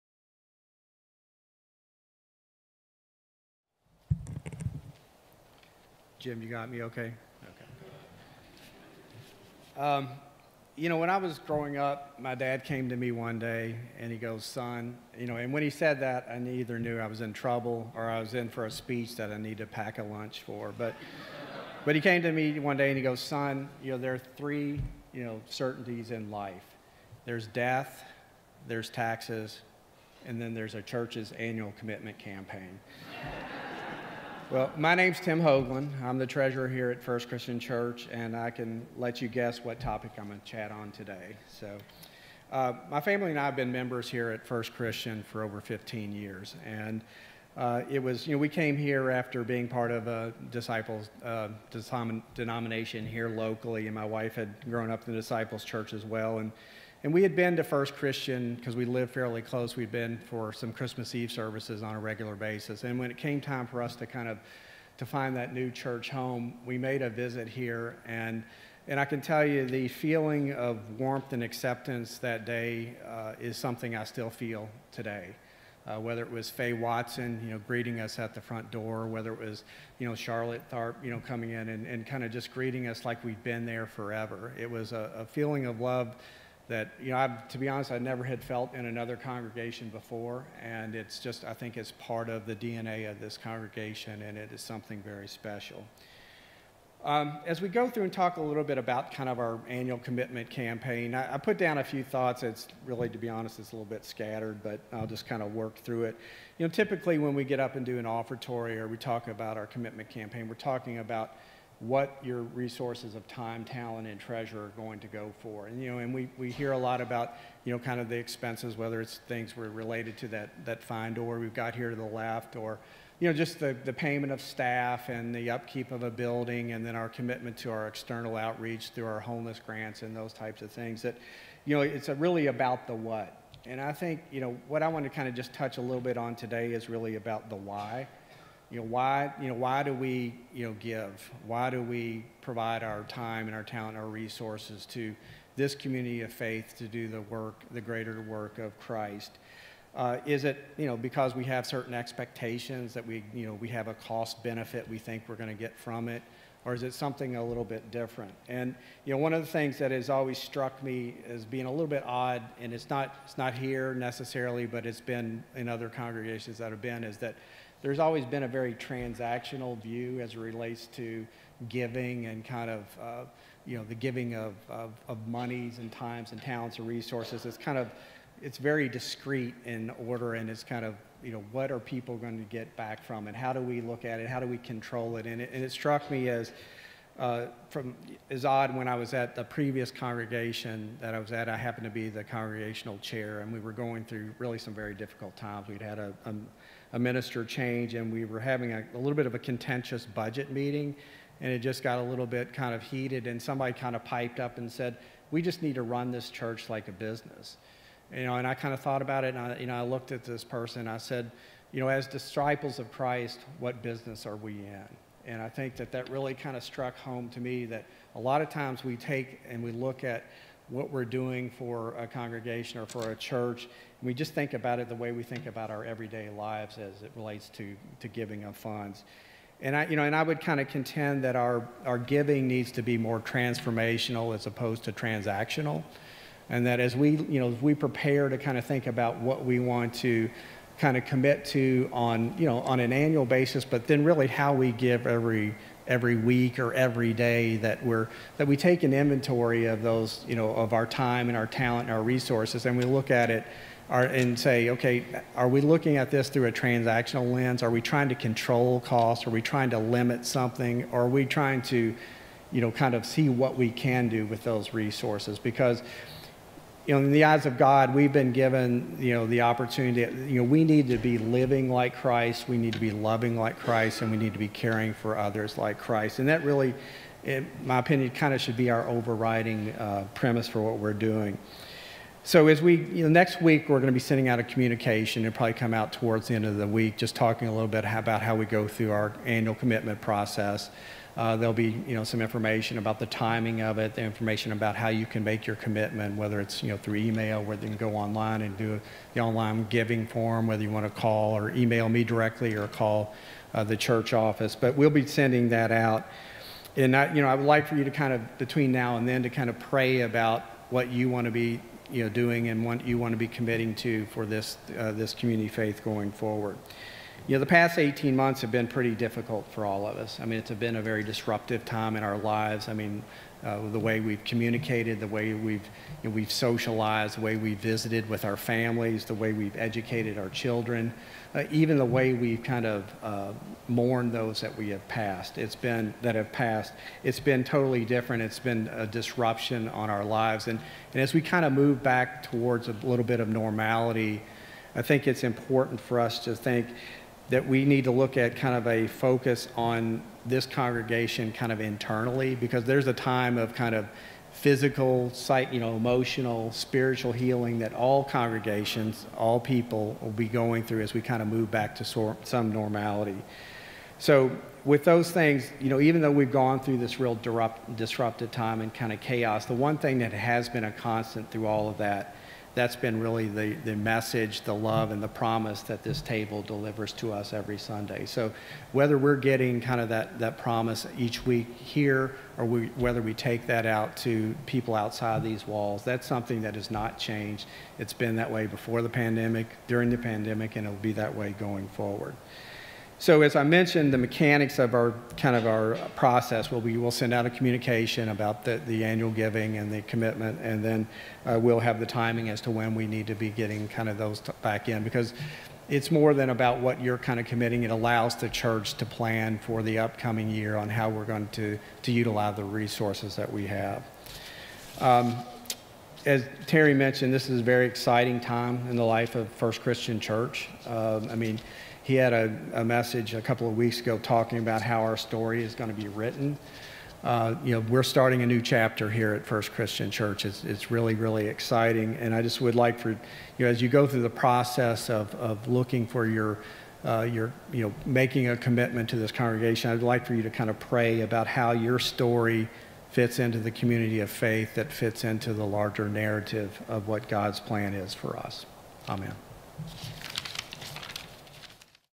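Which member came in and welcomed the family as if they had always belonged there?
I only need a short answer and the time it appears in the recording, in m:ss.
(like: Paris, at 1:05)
Charlotte Tharp, at 1:20.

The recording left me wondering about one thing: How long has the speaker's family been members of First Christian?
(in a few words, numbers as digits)
Over 15 years.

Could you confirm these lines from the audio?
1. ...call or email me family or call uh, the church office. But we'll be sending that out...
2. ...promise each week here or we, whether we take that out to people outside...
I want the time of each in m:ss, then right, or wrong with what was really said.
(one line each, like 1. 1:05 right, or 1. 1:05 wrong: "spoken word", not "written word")
1. 5:01 wrong: "directly", not "family"
2. 6:20 right.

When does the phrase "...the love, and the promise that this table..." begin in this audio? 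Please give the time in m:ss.
6:14.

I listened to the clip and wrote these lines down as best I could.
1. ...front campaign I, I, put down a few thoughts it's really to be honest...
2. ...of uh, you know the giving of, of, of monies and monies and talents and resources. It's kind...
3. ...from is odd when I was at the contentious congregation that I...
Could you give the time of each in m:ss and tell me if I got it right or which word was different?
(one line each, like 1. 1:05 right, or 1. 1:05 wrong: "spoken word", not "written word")
1. 1:39 wrong: "commitment", not "front"
2. 2:52 wrong: "times", not "monies"
3. 3:07 wrong: "previous", not "contentious".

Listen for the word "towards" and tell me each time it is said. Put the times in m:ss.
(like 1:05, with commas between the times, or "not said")
4:45, 5:42.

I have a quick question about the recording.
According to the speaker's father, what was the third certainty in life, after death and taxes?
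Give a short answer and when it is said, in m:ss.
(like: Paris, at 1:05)
A church's annual commitment campaign, at 0:30.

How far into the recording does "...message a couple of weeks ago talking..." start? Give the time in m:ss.
7:02.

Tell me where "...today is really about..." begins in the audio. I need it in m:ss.
2:16.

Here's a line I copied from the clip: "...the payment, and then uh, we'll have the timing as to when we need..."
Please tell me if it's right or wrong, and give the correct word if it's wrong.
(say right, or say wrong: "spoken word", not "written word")
wrong: "commitment", not "payment".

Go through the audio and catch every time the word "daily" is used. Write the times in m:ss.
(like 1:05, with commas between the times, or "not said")
not said.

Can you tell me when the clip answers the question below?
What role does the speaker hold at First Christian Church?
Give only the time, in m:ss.
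0:36.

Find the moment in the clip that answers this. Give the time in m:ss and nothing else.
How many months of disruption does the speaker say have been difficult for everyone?
5:17.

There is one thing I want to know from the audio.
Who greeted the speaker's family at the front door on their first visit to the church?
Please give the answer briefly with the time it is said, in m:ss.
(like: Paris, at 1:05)
Faye Watson, at 1:16.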